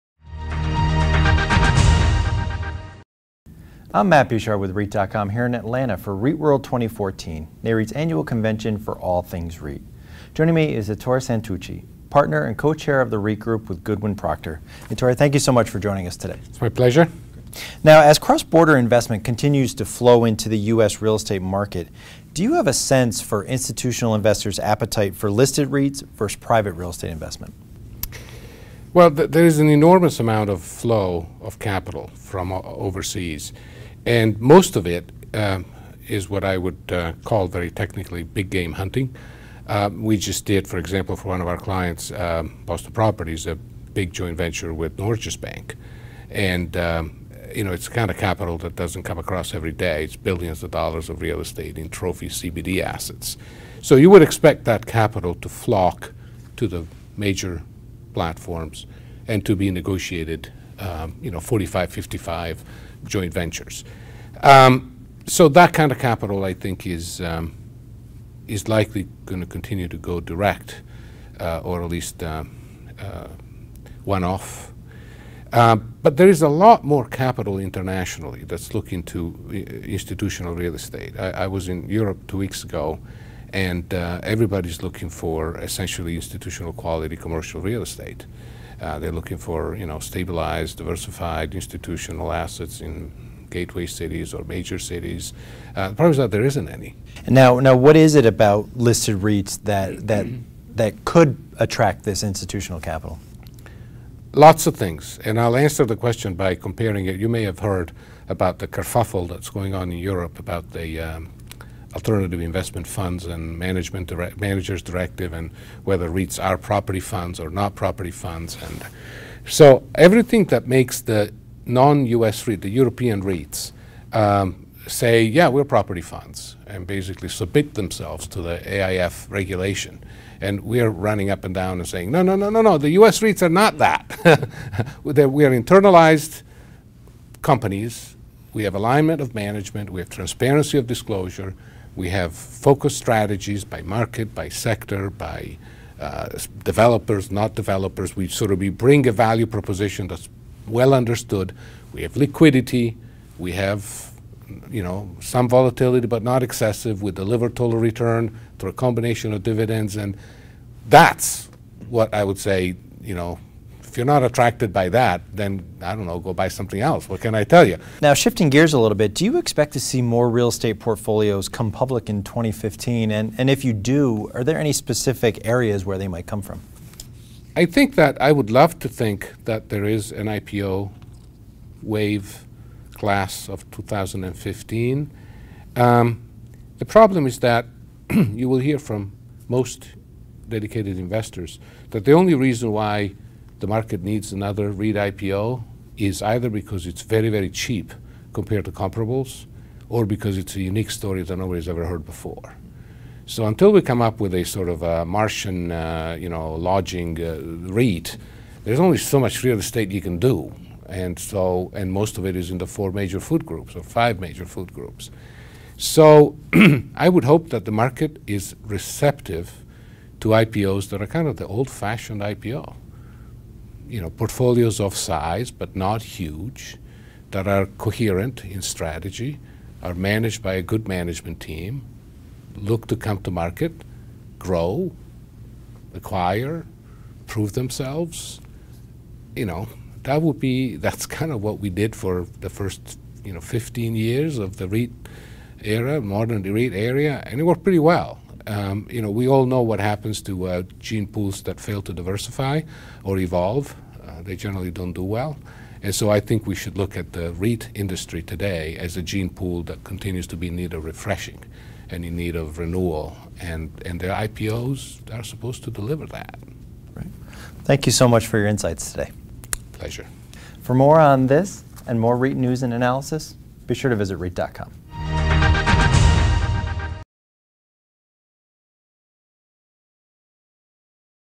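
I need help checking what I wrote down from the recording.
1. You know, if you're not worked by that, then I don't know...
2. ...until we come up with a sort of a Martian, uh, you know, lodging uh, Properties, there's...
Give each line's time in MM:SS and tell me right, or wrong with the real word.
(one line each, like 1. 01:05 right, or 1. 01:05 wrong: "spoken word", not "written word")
1. 02:43 wrong: "attracted", not "worked"
2. 03:23 wrong: "REIT", not "Properties".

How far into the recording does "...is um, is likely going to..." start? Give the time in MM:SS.
01:06.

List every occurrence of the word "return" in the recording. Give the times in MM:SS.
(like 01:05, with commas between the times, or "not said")
02:37.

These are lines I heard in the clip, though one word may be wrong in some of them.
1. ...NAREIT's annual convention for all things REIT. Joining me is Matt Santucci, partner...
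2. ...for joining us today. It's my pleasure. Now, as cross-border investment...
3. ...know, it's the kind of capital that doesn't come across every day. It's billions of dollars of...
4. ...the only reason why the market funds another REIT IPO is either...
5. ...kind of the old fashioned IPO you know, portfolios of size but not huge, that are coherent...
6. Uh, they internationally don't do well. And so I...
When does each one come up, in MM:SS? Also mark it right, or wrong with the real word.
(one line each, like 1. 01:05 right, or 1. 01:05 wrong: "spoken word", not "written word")
1. 00:07 wrong: "Ettore", not "Matt"
2. 00:15 right
3. 00:47 right
4. 03:12 wrong: "needs", not "funds"
5. 03:41 right
6. 04:14 wrong: "generally", not "internationally".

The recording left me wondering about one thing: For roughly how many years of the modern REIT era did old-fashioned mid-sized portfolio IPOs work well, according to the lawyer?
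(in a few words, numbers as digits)
15 years.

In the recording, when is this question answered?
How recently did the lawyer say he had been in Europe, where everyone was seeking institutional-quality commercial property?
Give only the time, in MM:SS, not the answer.
01:22.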